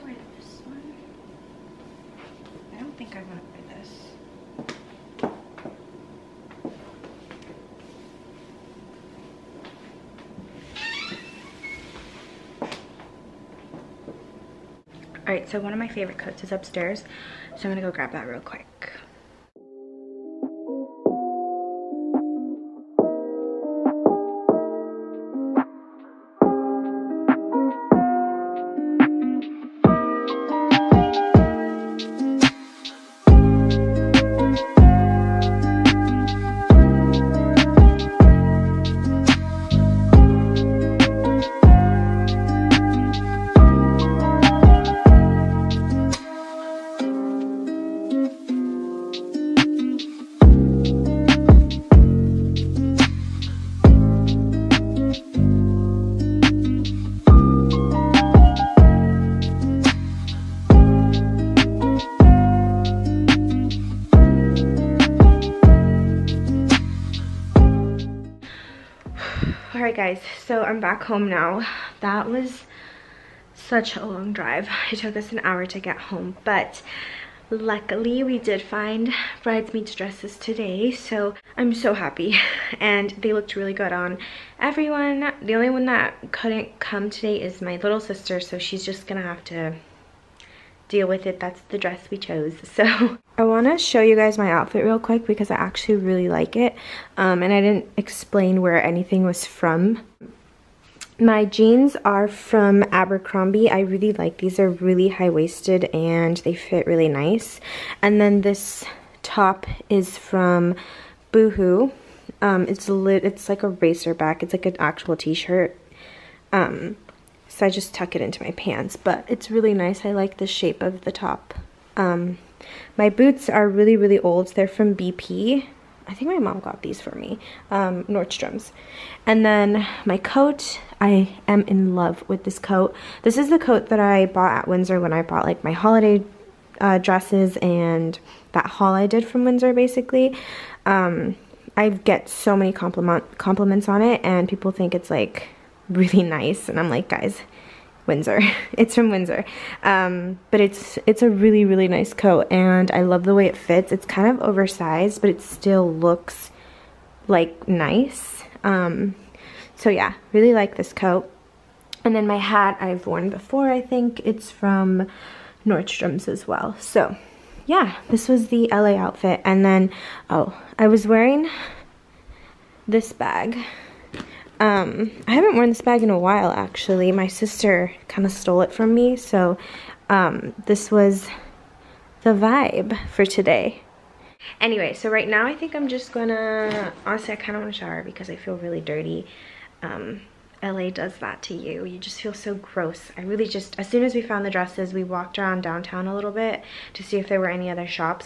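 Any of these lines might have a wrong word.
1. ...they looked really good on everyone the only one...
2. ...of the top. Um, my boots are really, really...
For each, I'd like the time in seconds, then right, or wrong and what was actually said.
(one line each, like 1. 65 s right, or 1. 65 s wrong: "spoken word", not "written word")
1. 83 s right
2. 120 s right.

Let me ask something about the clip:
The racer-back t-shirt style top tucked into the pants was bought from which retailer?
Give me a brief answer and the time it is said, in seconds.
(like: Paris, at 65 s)
Boohoo, at 111 s.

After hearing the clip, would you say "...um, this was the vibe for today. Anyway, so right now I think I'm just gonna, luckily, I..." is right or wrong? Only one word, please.
wrong.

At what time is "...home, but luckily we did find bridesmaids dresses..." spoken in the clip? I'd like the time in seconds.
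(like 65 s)
75 s.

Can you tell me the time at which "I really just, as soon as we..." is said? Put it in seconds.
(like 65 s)
193 s.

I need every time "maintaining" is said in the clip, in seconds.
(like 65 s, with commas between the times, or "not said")
not said.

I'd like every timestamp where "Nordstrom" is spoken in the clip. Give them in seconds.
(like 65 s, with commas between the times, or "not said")
128 s, 165 s.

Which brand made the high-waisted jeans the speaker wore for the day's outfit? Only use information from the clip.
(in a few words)
Abercrombie.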